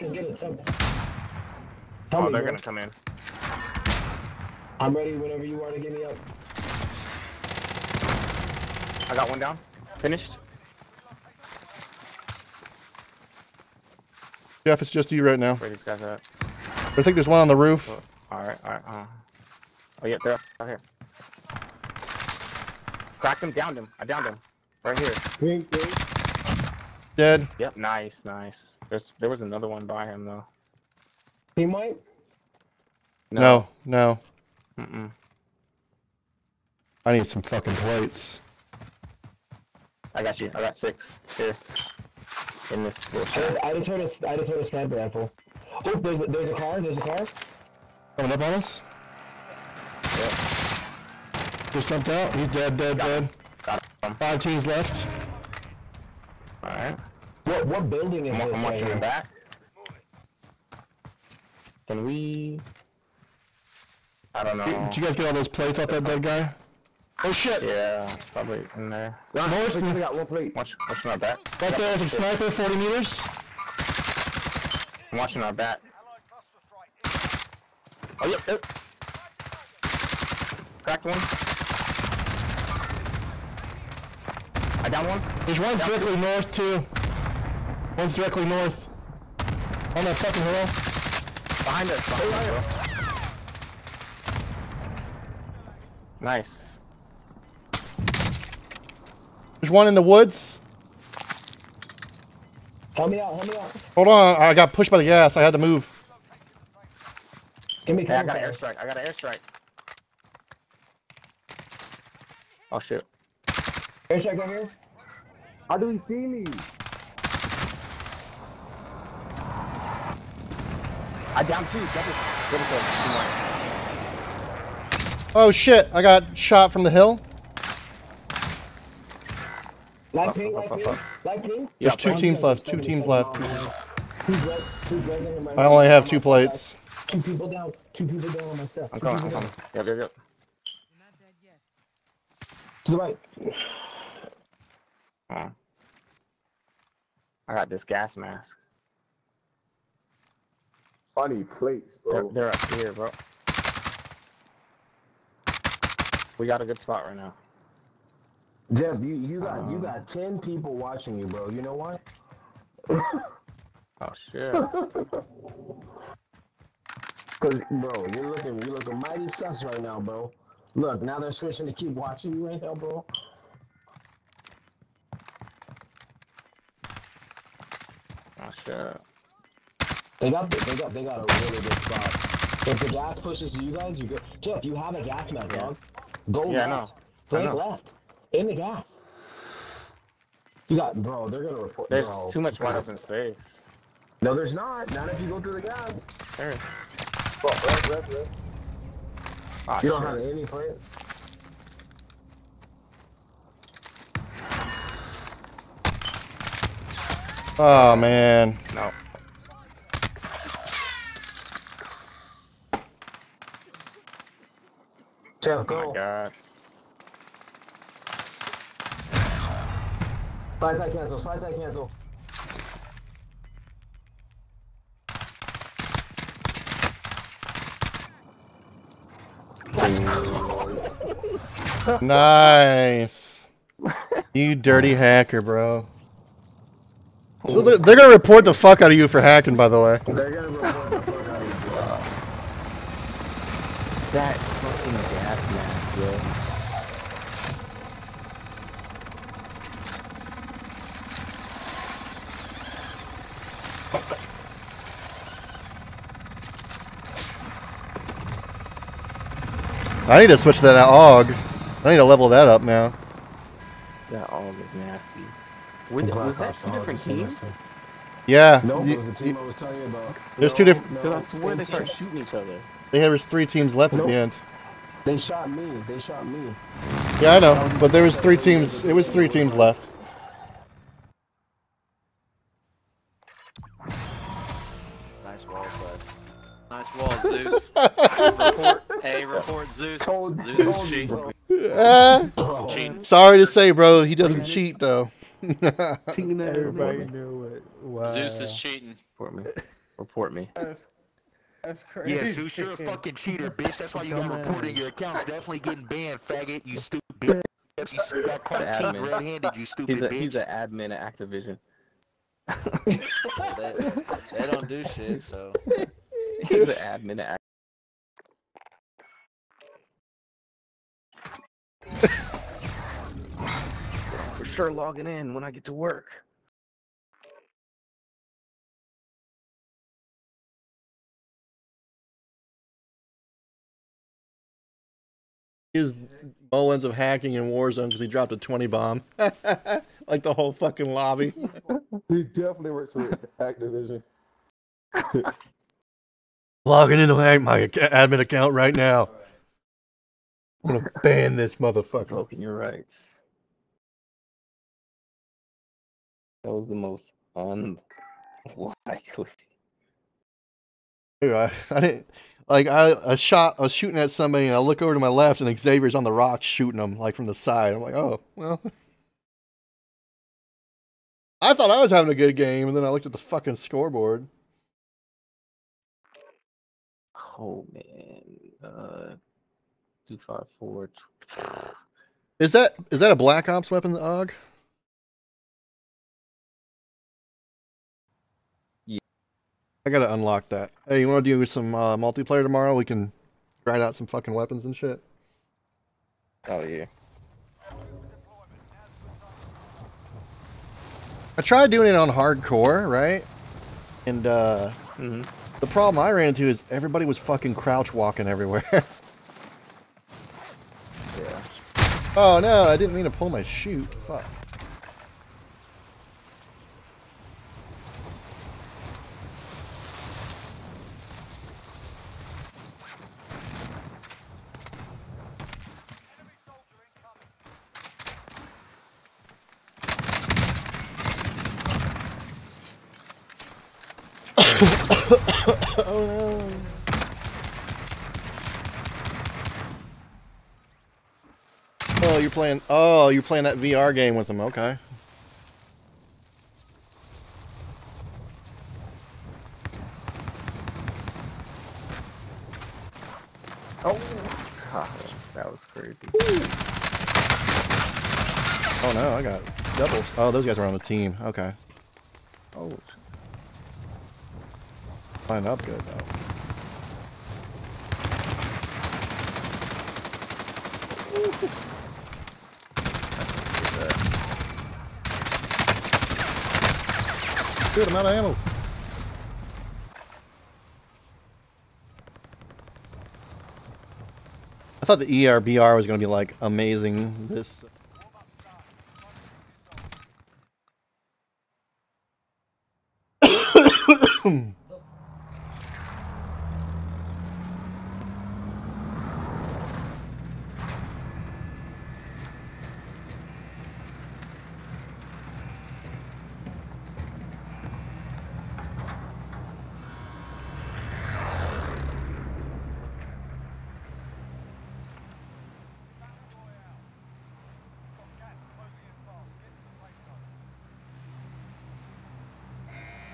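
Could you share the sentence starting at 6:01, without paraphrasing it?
Dude, I, I didn't like I a shot.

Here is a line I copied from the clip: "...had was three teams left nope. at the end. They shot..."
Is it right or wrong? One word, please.
right.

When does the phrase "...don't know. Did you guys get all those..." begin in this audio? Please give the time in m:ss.
1:04.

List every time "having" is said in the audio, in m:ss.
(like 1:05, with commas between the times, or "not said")
6:11.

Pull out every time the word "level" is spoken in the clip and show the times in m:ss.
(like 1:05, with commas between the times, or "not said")
4:22.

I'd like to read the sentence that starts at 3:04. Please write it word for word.
Jeff, you have a gas mask, dog.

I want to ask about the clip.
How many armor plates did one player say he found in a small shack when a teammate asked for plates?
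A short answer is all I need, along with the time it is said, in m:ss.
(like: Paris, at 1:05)
6, at 0:40.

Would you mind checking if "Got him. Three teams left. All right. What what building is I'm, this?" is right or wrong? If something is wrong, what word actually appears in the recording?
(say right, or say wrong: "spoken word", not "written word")
wrong: "Five", not "Three".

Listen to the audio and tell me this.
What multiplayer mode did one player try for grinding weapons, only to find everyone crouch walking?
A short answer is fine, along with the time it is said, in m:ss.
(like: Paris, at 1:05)
Hardcore, at 6:42.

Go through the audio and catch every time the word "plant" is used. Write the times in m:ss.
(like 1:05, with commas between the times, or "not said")
3:20.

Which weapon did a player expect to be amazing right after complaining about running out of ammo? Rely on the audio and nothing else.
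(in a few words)
ERBR.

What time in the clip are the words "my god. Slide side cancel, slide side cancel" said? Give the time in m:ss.
3:35.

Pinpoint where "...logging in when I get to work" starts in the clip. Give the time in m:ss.
5:24.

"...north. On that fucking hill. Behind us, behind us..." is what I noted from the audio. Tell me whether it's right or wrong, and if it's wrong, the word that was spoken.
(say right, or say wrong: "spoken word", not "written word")
right.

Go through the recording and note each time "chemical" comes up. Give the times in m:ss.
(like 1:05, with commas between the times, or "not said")
not said.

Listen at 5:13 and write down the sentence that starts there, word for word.
well, they, they don't do shit, so he's an admin at.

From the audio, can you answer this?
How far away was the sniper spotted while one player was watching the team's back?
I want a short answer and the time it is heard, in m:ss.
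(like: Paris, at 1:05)
40 meters, at 1:12.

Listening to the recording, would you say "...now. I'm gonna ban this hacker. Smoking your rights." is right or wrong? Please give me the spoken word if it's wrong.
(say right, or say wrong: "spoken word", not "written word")
wrong: "motherfucker", not "hacker".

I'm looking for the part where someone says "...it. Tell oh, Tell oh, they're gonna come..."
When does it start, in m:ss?
0:00.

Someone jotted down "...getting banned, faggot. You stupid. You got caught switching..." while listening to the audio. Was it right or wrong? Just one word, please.
wrong.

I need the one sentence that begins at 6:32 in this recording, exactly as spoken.
We can grind out some fucking weapons and shit.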